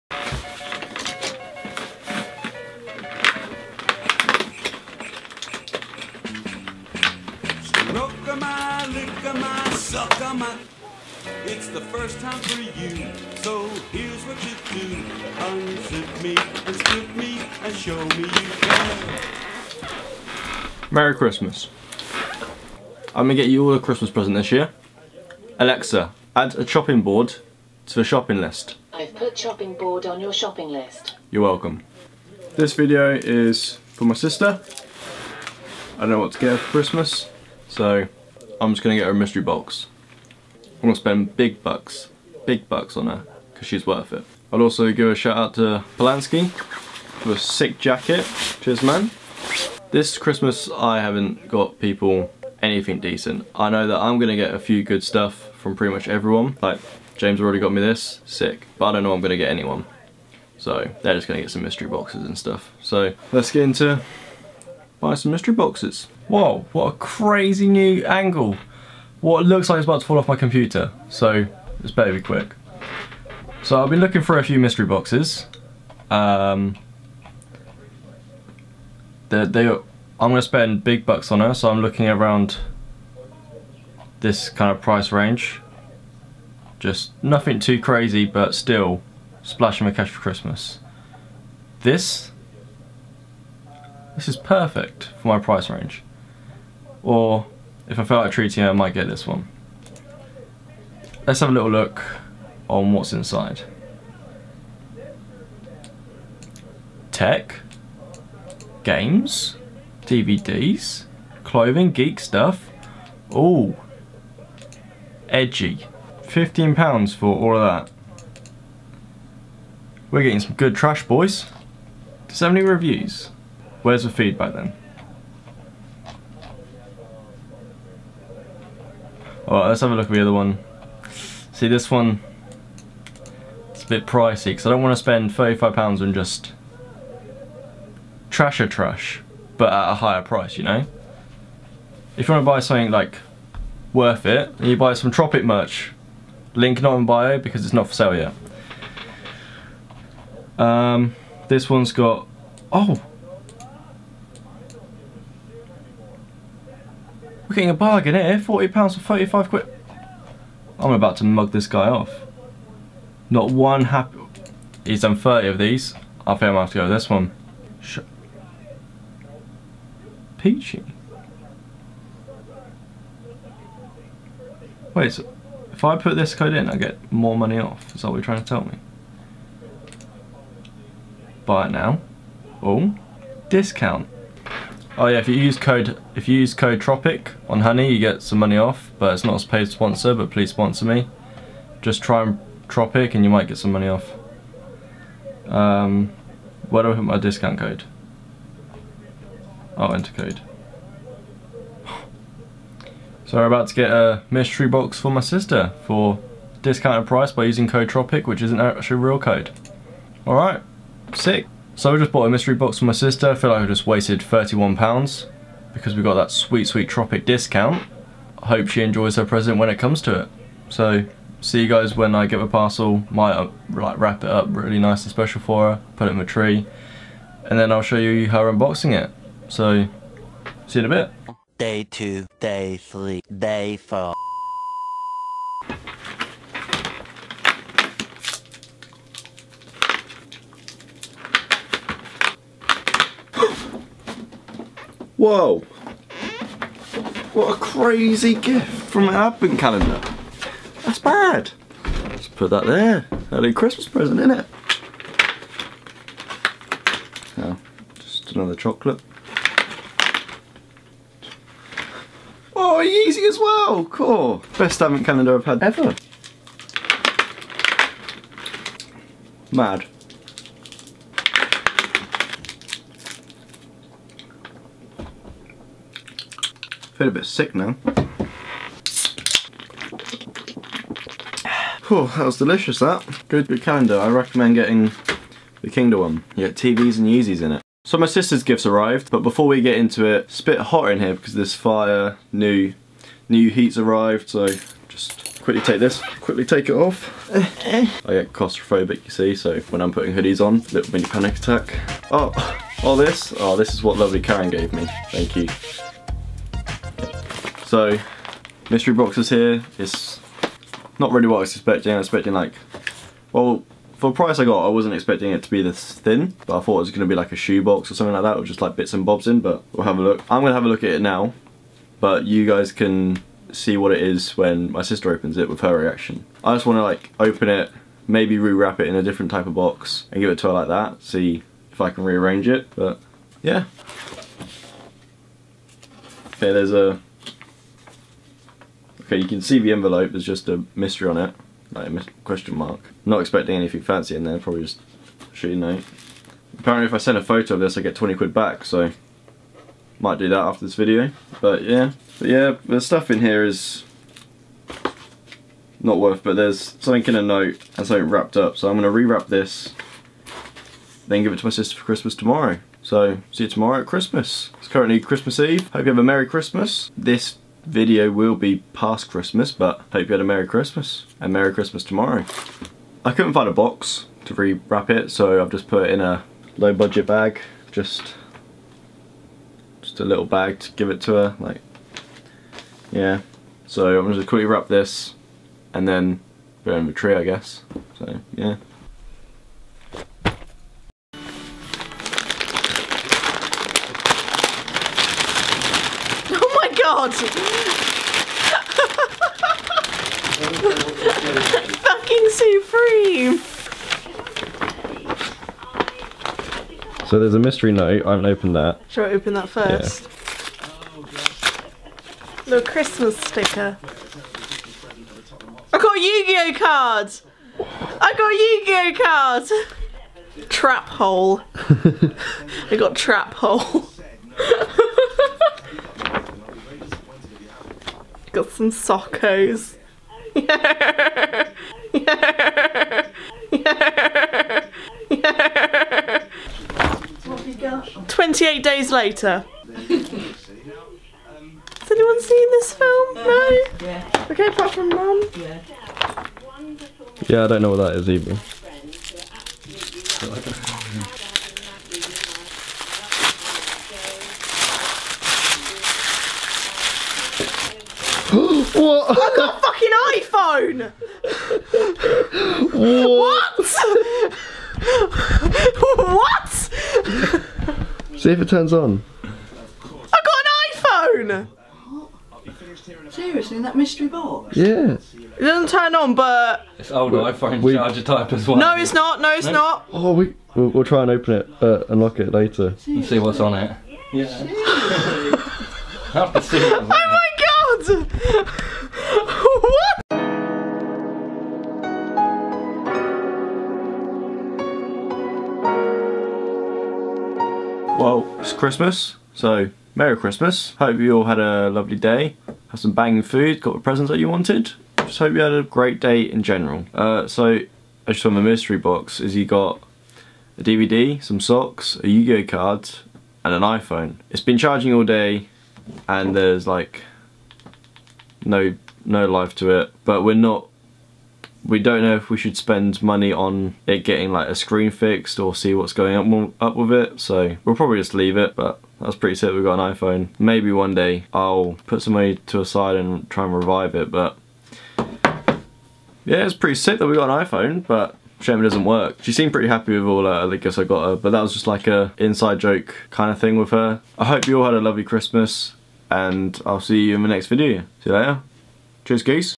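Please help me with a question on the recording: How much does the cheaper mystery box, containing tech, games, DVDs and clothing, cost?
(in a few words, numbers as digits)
£15.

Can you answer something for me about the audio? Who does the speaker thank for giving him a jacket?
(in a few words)
Polanski.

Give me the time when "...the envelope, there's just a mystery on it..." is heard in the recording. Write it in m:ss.
5:39.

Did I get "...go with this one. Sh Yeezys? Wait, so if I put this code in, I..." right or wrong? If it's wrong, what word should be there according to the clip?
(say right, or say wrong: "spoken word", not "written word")
wrong: "Peachy", not "Yeezys".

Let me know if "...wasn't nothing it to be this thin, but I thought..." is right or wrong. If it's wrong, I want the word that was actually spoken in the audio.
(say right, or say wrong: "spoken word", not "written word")
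wrong: "expecting", not "nothing".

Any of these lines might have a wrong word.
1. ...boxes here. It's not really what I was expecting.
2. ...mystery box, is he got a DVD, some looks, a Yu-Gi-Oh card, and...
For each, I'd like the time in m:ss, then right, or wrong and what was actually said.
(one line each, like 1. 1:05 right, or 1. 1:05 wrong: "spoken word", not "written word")
1. 5:08 right
2. 8:28 wrong: "socks", not "looks".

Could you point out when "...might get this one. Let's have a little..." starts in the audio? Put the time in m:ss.
1:38.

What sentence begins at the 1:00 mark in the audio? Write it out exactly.
So, they're just gonna get some mystery boxes and stuff.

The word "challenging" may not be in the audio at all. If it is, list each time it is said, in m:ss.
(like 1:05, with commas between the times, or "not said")
not said.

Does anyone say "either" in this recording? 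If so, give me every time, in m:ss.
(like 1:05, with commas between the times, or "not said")
7:28.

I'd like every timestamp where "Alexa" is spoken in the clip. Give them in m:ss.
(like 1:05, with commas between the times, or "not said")
0:25.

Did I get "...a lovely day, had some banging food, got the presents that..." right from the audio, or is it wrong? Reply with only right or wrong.
right.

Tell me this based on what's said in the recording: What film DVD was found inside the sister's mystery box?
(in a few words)
28 Days Later.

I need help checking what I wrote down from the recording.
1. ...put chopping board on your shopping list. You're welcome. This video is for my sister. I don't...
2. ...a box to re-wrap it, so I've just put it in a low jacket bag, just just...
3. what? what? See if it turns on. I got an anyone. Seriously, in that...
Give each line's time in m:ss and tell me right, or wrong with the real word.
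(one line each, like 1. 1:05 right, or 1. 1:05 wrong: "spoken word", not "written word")
1. 0:29 right
2. 6:13 wrong: "budget", not "jacket"
3. 7:42 wrong: "iPhone", not "anyone".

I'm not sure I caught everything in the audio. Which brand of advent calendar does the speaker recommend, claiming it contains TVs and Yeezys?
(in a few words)
Kingdom.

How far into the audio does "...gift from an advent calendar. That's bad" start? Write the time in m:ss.
4:08.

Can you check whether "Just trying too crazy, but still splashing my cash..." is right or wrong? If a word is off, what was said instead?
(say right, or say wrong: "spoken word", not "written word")
wrong: "nothing", not "trying".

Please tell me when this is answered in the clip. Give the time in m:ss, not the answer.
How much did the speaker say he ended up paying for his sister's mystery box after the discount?
3:34.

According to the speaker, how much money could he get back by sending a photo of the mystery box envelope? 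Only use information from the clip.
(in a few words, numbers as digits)
£20.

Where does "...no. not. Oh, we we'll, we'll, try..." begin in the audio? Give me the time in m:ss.
7:59.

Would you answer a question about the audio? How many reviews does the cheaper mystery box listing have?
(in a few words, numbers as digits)
70.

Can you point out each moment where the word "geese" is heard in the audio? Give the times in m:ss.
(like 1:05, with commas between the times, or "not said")
9:09.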